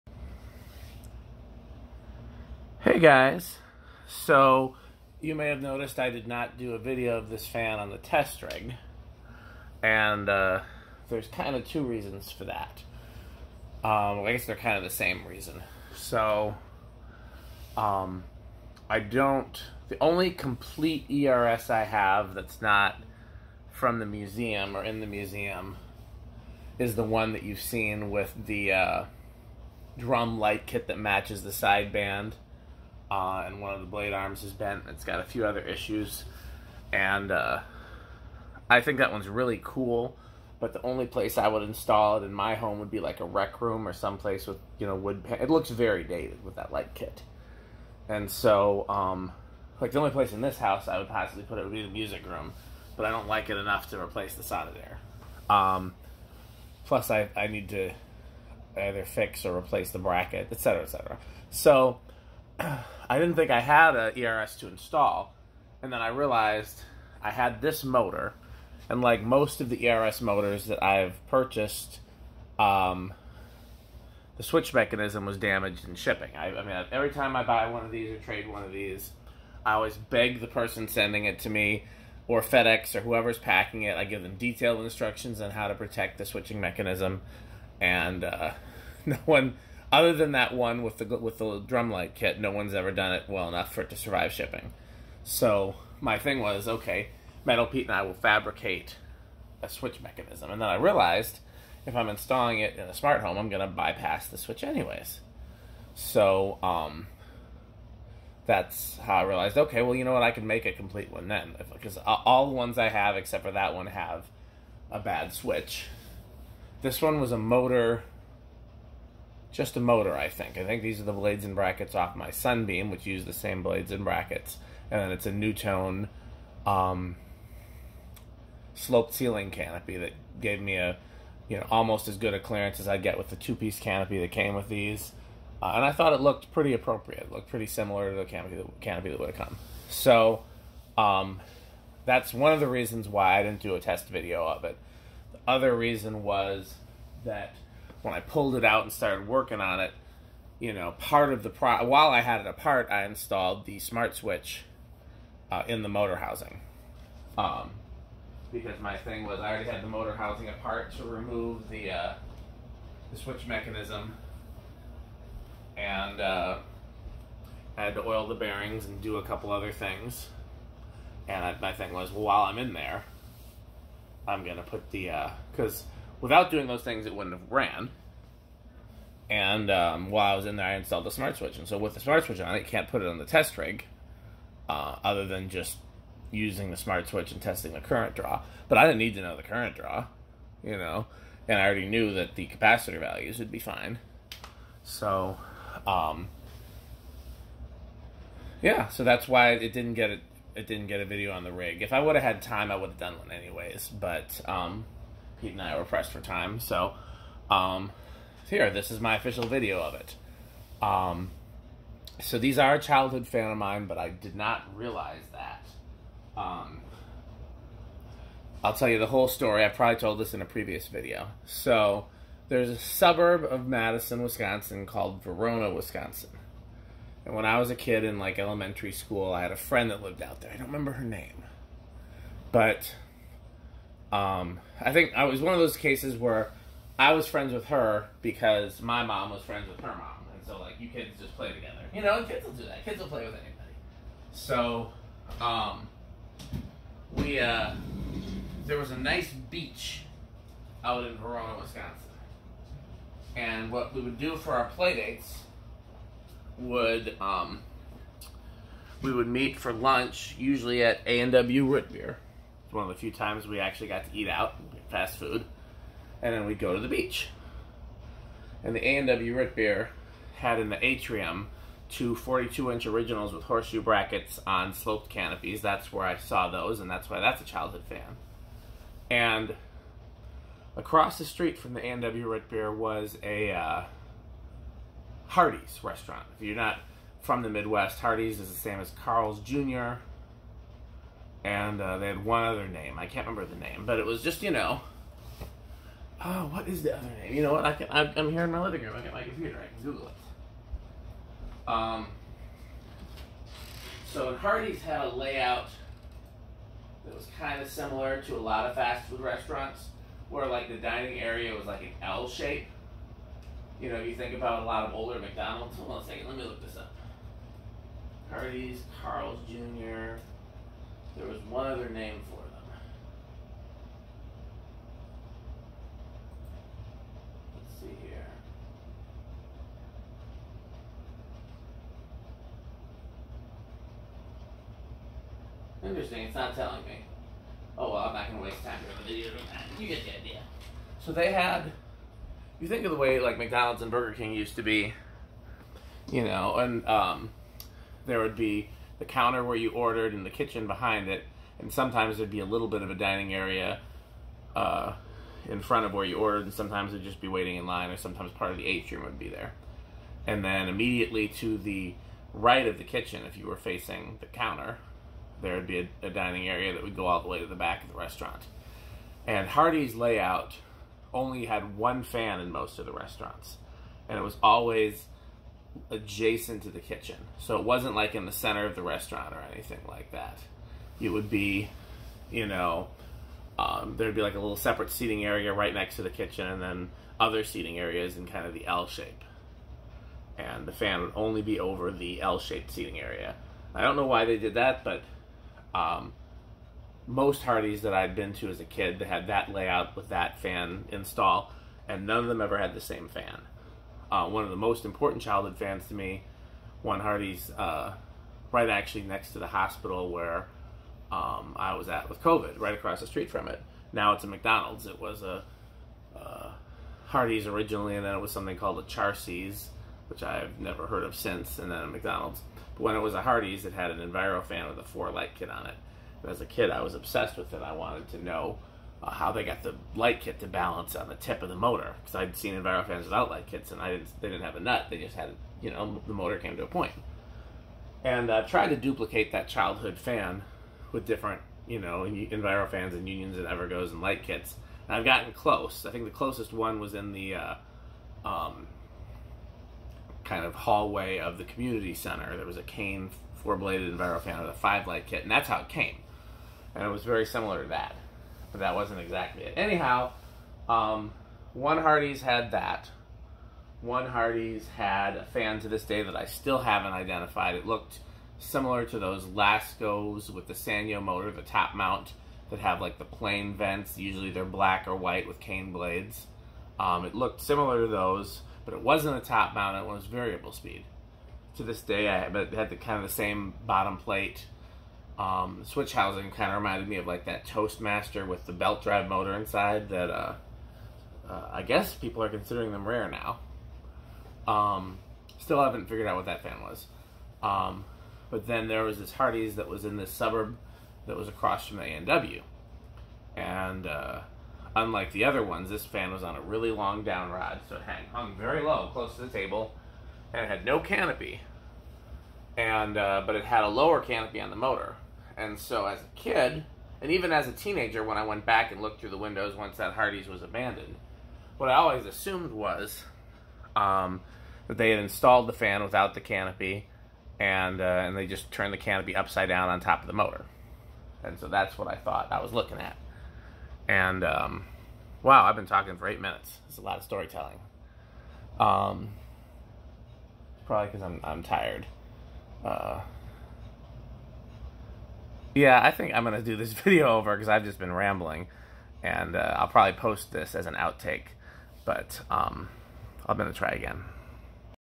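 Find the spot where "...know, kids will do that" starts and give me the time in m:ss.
4:02.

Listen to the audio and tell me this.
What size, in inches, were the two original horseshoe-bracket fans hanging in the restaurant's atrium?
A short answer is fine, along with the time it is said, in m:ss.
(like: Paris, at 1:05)
42, at 4:32.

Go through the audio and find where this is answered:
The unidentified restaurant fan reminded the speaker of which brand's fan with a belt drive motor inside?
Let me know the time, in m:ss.
8:07.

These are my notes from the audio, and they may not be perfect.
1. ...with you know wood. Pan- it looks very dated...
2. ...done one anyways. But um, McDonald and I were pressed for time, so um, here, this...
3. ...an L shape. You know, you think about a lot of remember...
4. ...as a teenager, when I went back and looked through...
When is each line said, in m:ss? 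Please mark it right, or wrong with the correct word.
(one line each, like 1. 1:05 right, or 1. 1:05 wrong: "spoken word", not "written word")
1. 0:44 right
2. 3:22 wrong: "Pete", not "McDonald"
3. 5:11 wrong: "older", not "remember"
4. 8:37 right.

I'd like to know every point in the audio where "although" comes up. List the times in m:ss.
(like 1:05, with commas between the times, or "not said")
not said.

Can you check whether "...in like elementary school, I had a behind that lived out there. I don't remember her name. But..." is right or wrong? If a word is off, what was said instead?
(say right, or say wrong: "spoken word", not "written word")
wrong: "friend", not "behind".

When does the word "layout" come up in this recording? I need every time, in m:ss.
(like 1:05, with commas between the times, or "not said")
5:05, 6:09, 6:39.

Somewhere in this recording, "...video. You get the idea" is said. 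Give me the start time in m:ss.
5:39.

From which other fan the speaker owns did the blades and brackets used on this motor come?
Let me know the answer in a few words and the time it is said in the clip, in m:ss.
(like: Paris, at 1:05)
Sunbeam, at 2:02.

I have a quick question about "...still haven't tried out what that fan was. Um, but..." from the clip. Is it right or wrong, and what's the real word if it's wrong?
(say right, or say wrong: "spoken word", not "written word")
wrong: "figured", not "tried".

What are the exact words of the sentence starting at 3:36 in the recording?
Um, I'll tell you the whole story.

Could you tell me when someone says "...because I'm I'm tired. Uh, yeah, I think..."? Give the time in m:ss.
9:00.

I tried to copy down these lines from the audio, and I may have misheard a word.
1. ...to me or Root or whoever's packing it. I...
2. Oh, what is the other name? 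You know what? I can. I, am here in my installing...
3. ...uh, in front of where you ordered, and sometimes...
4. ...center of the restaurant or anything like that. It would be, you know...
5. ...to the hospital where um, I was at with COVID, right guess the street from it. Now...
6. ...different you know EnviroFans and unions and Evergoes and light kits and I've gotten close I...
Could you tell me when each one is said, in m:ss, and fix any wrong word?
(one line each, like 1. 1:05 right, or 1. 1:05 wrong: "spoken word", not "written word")
1. 1:21 wrong: "FedEx", not "Root"
2. 4:56 wrong: "living", not "installing"
3. 5:54 right
4. 6:18 right
5. 6:49 wrong: "across", not "guess"
6. 7:21 right.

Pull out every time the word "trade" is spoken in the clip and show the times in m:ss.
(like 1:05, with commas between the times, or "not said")
1:18.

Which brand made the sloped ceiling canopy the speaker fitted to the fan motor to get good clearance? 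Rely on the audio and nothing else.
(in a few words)
NuTone.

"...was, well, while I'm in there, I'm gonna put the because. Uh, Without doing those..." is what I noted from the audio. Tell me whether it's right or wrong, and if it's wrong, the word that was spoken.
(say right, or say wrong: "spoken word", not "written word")
right.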